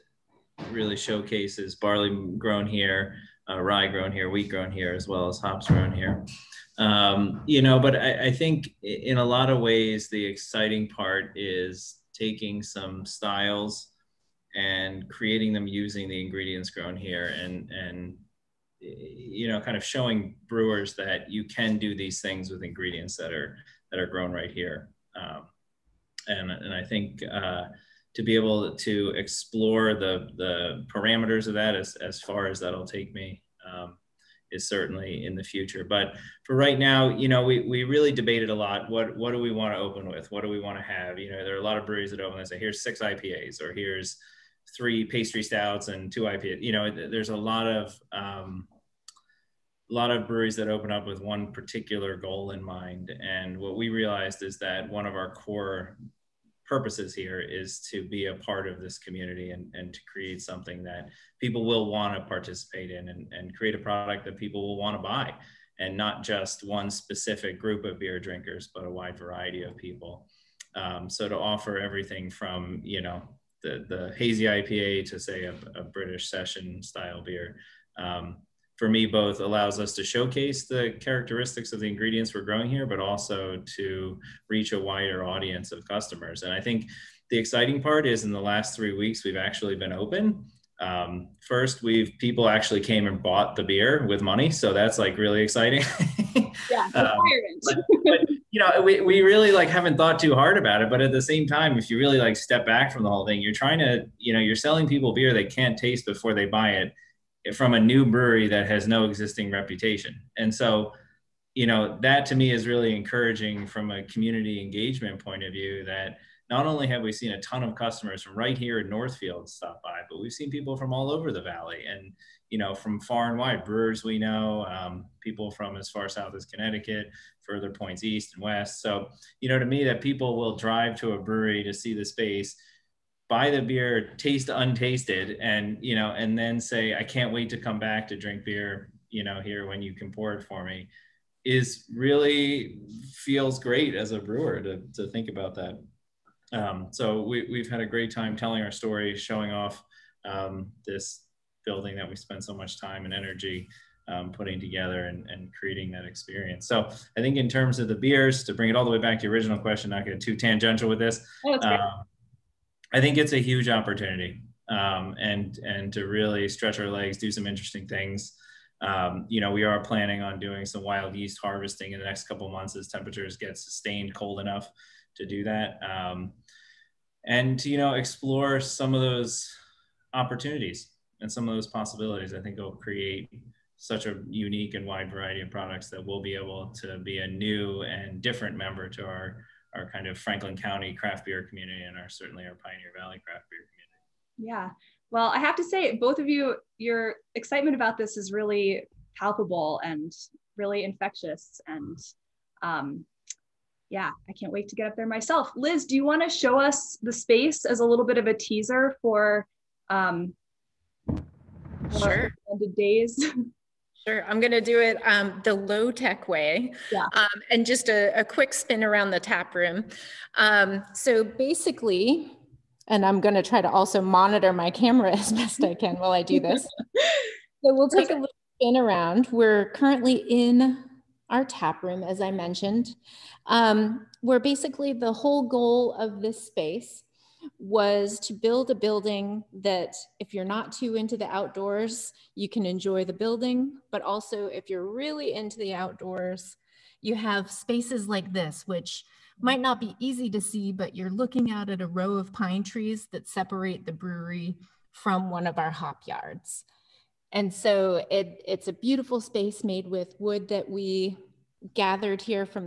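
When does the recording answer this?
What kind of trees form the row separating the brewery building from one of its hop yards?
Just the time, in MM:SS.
04:12.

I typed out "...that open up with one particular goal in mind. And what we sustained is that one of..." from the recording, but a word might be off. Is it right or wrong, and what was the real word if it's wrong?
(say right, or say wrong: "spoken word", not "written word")
wrong: "realized", not "sustained".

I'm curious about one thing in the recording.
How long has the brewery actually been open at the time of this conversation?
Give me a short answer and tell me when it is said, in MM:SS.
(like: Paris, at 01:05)
3 weeks, at 01:28.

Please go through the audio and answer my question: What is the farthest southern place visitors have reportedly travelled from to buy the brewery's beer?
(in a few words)
Connecticut.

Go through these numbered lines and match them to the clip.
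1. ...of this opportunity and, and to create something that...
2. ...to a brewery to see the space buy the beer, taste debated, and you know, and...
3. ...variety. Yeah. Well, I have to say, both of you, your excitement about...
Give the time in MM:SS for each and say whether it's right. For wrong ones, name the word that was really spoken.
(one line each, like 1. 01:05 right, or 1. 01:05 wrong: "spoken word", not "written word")
1. 00:58 wrong: "community", not "opportunity"
2. 02:10 wrong: "untasted", not "debated"
3. 03:13 wrong: "community", not "variety".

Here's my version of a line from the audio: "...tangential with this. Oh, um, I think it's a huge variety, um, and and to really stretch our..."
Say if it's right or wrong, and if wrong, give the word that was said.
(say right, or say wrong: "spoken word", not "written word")
wrong: "opportunity", not "variety".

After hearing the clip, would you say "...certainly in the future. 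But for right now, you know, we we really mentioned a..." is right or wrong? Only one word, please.
wrong.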